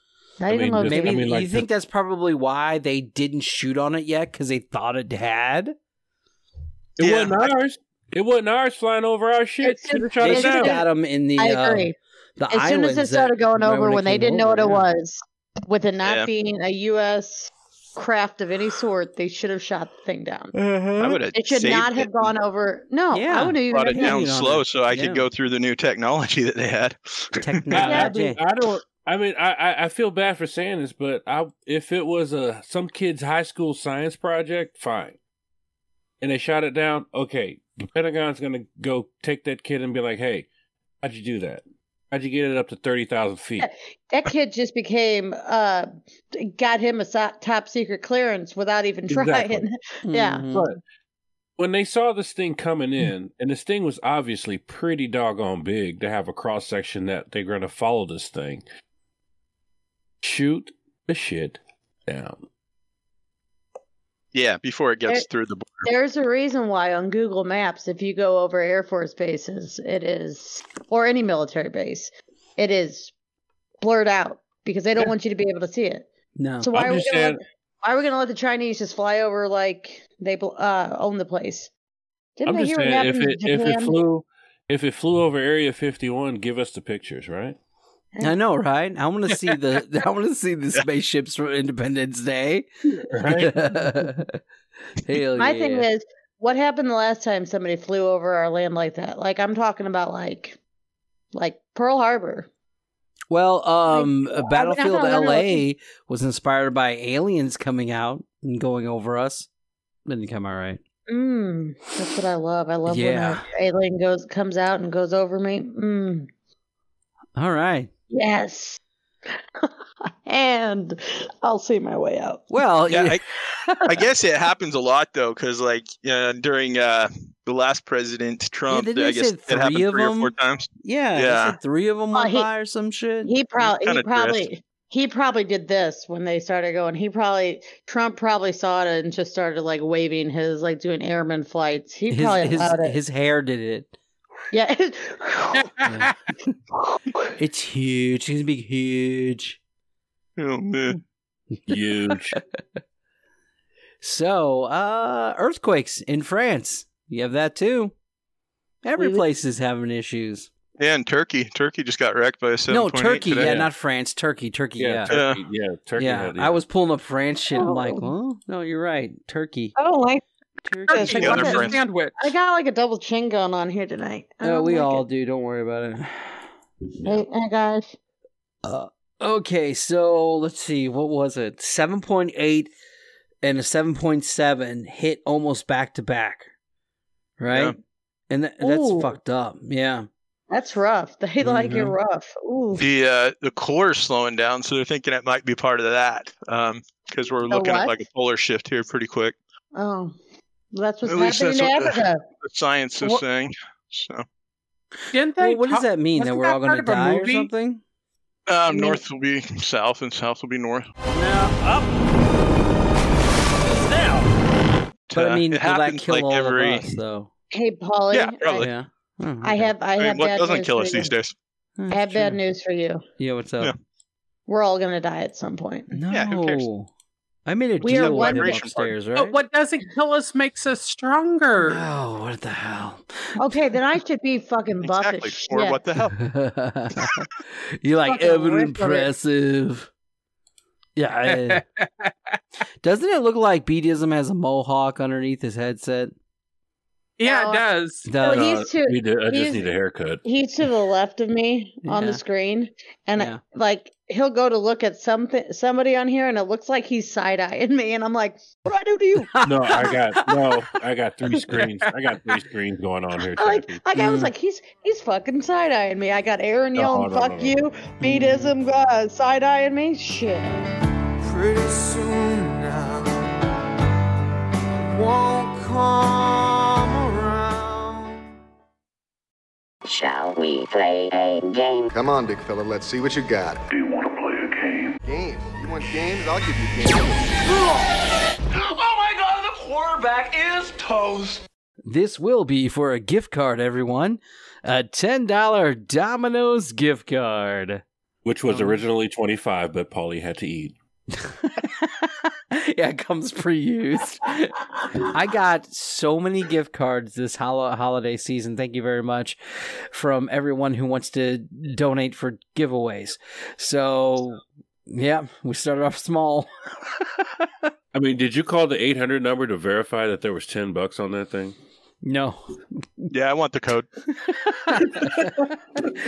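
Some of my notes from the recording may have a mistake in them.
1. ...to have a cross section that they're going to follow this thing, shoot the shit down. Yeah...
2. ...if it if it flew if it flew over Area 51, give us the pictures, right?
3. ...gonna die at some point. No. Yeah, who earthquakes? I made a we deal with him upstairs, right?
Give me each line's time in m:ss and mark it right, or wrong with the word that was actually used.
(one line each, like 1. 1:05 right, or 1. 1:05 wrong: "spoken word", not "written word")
1. 0:56 right
2. 1:23 right
3. 3:44 wrong: "cares", not "earthquakes".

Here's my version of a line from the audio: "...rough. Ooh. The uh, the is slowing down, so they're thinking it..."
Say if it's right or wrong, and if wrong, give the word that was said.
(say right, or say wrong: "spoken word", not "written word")
right.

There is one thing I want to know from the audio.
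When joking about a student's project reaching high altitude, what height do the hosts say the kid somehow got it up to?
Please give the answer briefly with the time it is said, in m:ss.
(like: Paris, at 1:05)
30,000 feet, at 0:42.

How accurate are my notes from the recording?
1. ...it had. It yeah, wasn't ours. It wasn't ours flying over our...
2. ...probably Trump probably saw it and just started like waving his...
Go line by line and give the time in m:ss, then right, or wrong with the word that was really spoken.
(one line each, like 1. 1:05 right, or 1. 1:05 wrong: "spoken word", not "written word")
1. 0:04 right
2. 2:17 right.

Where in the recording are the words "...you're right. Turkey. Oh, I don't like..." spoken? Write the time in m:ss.
2:48.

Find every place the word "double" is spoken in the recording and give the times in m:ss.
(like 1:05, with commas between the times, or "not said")
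2:52.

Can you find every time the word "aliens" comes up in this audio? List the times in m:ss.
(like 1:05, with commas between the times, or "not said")
1:46, 1:53.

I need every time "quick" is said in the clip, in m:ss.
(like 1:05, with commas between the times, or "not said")
3:19.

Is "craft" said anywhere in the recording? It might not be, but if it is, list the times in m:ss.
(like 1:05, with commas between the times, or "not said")
0:17.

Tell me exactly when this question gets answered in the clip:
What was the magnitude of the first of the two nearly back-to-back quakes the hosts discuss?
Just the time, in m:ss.
3:01.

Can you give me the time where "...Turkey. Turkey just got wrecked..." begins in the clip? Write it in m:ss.
2:41.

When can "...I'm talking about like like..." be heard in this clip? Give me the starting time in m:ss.
1:39.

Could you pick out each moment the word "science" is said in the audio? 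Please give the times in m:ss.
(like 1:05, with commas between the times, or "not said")
0:33, 3:22.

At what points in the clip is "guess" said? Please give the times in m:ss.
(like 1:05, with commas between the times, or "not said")
2:03, 2:09.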